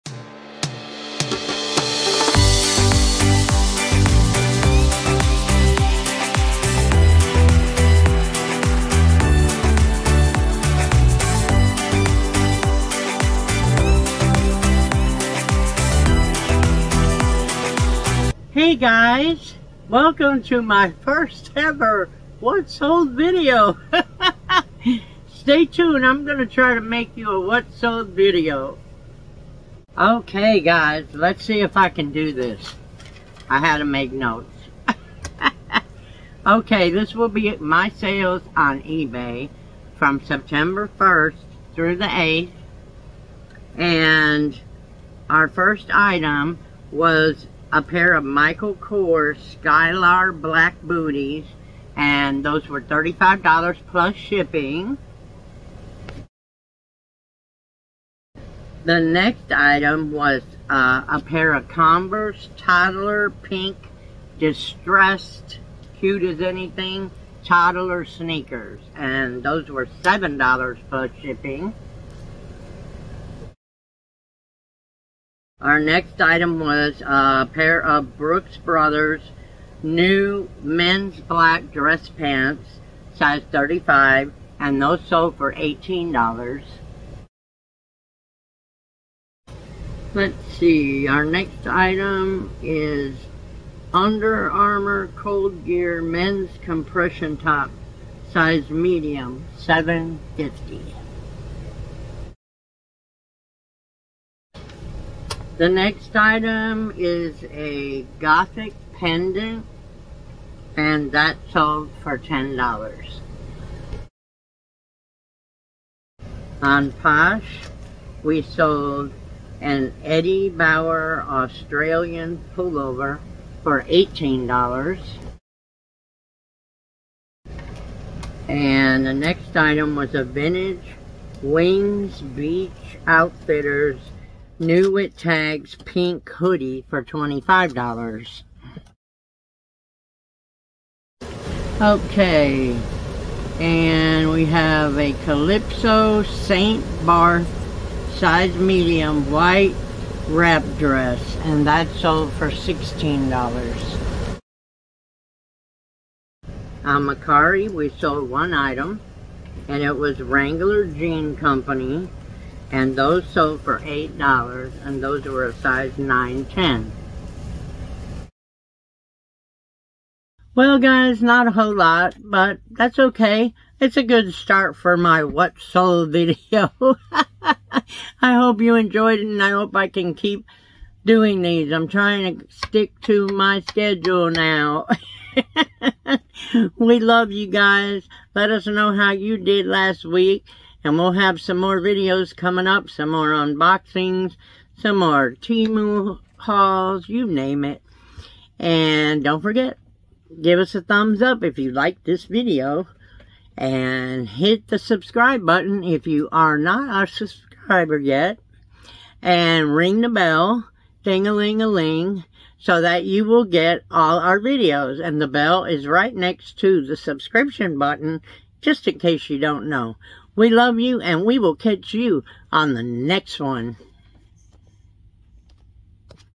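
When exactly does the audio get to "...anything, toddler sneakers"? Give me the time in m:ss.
1:06.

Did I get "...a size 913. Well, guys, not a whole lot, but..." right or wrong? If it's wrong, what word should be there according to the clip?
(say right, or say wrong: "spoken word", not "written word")
wrong: "910", not "913".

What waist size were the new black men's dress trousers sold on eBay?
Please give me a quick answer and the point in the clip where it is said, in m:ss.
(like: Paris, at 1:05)
35, at 1:23.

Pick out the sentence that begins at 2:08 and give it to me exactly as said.
And the next item was a vintage Wings Beach Outfitters New with tags pink hoodie for $25.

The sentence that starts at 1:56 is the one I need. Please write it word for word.
On Posh, we sold an Eddie Bauer Australian pullover for $18.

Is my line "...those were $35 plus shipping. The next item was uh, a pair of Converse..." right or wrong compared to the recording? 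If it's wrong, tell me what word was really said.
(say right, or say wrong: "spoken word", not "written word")
right.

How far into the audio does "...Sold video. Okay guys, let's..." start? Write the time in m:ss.
0:27.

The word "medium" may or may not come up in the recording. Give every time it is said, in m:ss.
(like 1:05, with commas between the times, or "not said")
1:38, 2:28.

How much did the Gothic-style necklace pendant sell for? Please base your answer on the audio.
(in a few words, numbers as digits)
$10.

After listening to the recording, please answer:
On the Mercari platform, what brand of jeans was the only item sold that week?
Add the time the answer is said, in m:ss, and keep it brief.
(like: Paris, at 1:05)
Wrangler, at 2:40.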